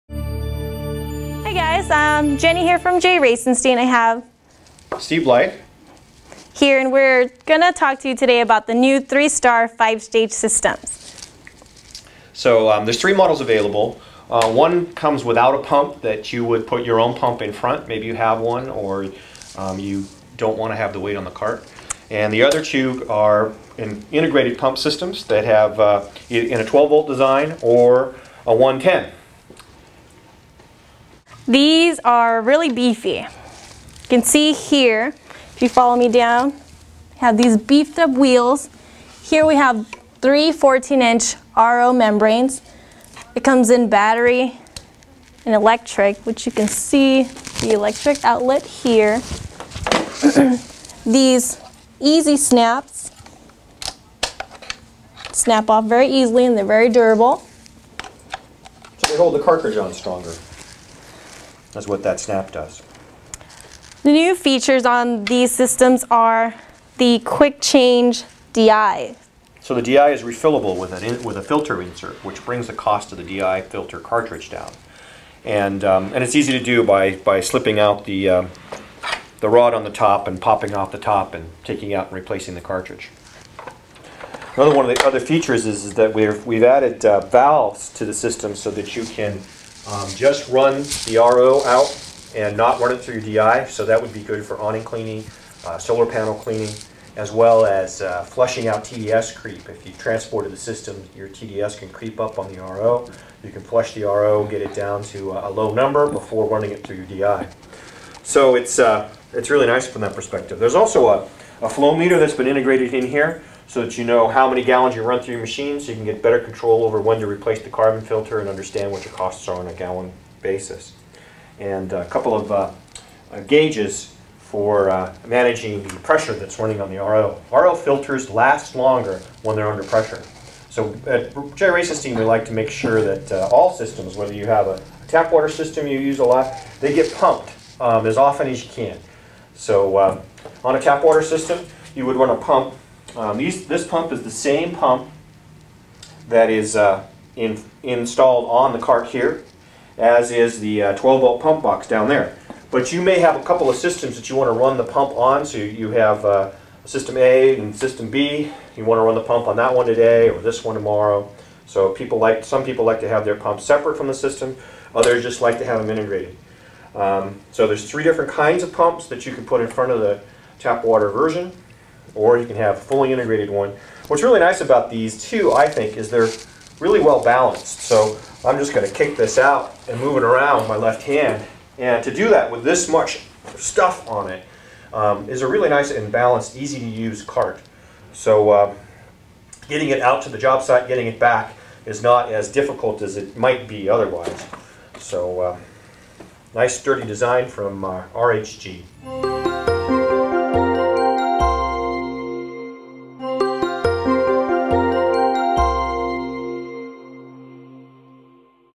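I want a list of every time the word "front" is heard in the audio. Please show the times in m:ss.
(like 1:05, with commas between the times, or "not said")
0:17, 2:49.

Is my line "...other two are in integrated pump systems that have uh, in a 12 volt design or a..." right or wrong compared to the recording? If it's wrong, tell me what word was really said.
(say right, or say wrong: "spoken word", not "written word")
right.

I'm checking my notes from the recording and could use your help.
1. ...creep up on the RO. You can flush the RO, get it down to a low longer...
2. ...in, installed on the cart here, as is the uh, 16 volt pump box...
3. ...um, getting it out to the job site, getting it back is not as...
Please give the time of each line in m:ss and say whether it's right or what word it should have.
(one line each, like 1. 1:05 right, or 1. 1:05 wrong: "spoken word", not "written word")
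1. 1:41 wrong: "number", not "longer"
2. 2:27 wrong: "12", not "16"
3. 3:08 right.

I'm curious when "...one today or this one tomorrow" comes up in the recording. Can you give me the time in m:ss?
2:39.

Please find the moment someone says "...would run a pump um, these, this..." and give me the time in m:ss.
2:22.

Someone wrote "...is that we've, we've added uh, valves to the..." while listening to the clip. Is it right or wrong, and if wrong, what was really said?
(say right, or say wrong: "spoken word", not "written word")
right.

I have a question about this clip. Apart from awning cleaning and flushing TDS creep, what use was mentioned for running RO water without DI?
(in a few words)
Solar panel cleaning.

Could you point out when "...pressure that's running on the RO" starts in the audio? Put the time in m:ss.
2:06.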